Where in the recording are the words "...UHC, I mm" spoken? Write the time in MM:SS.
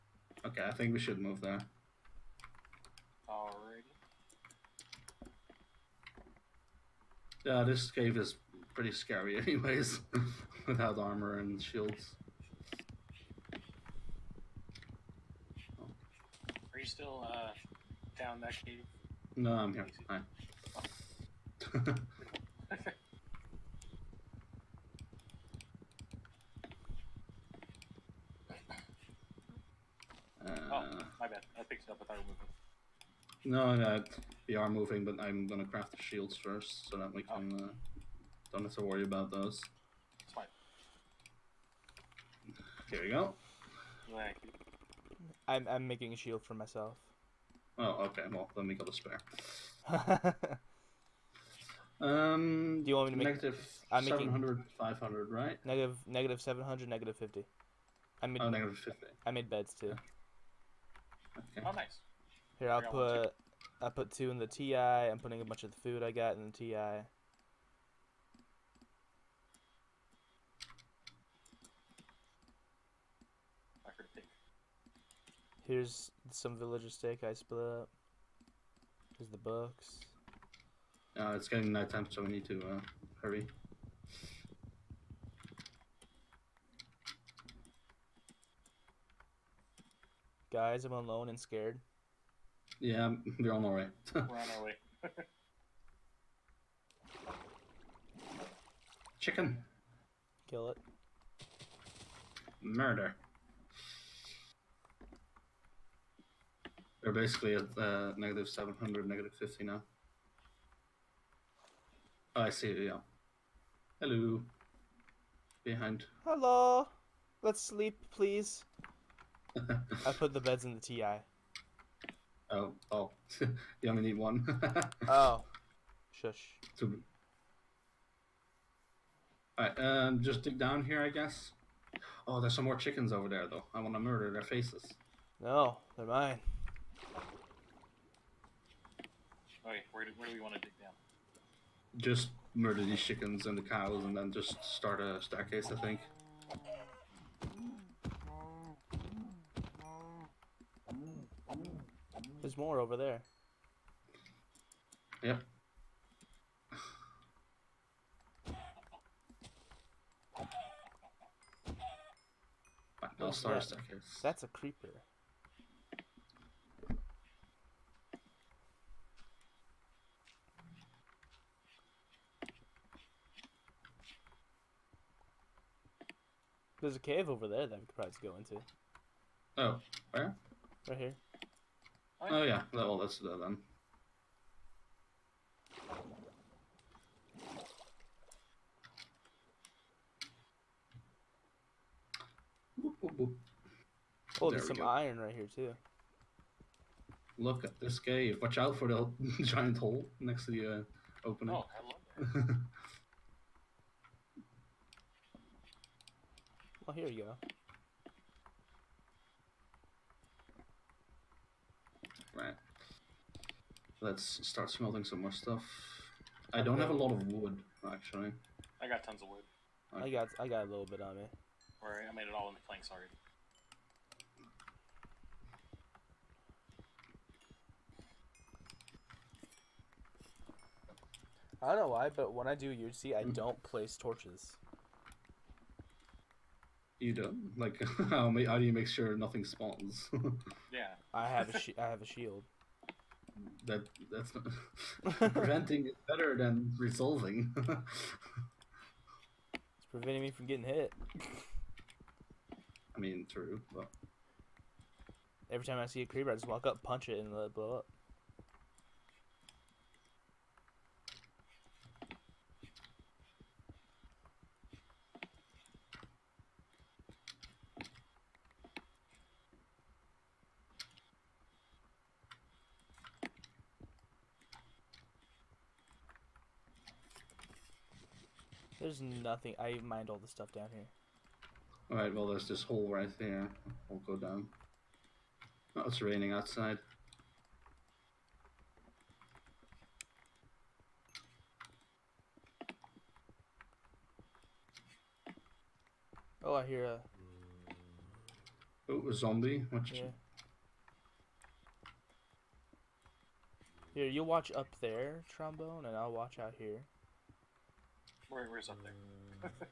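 03:52.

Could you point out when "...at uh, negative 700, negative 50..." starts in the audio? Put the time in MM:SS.
01:47.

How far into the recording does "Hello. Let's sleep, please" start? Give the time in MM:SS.
01:56.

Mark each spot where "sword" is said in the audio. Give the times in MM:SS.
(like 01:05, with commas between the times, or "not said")
not said.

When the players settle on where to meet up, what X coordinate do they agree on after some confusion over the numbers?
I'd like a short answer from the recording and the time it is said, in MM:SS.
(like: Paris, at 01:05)
-700, at 00:55.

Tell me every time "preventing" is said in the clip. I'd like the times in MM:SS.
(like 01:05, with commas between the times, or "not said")
04:05, 04:09.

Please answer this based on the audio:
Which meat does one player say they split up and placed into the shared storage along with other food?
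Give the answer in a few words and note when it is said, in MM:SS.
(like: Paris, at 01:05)
Villager steak, at 01:16.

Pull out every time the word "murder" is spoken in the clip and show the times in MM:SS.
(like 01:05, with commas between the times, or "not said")
01:42, 02:13, 02:22.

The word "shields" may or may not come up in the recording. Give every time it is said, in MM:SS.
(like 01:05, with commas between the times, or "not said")
00:11, 00:36, 00:46, 04:02.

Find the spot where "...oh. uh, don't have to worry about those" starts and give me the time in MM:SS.
00:37.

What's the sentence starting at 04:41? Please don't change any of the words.
Alright, well, there's this hole right there.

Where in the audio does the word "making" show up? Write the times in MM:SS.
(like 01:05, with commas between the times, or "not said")
00:45, 00:54.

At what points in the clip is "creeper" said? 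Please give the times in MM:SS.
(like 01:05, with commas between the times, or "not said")
02:44, 04:16.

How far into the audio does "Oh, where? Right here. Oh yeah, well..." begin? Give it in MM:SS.
02:59.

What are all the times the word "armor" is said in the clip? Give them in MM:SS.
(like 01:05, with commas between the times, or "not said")
00:10.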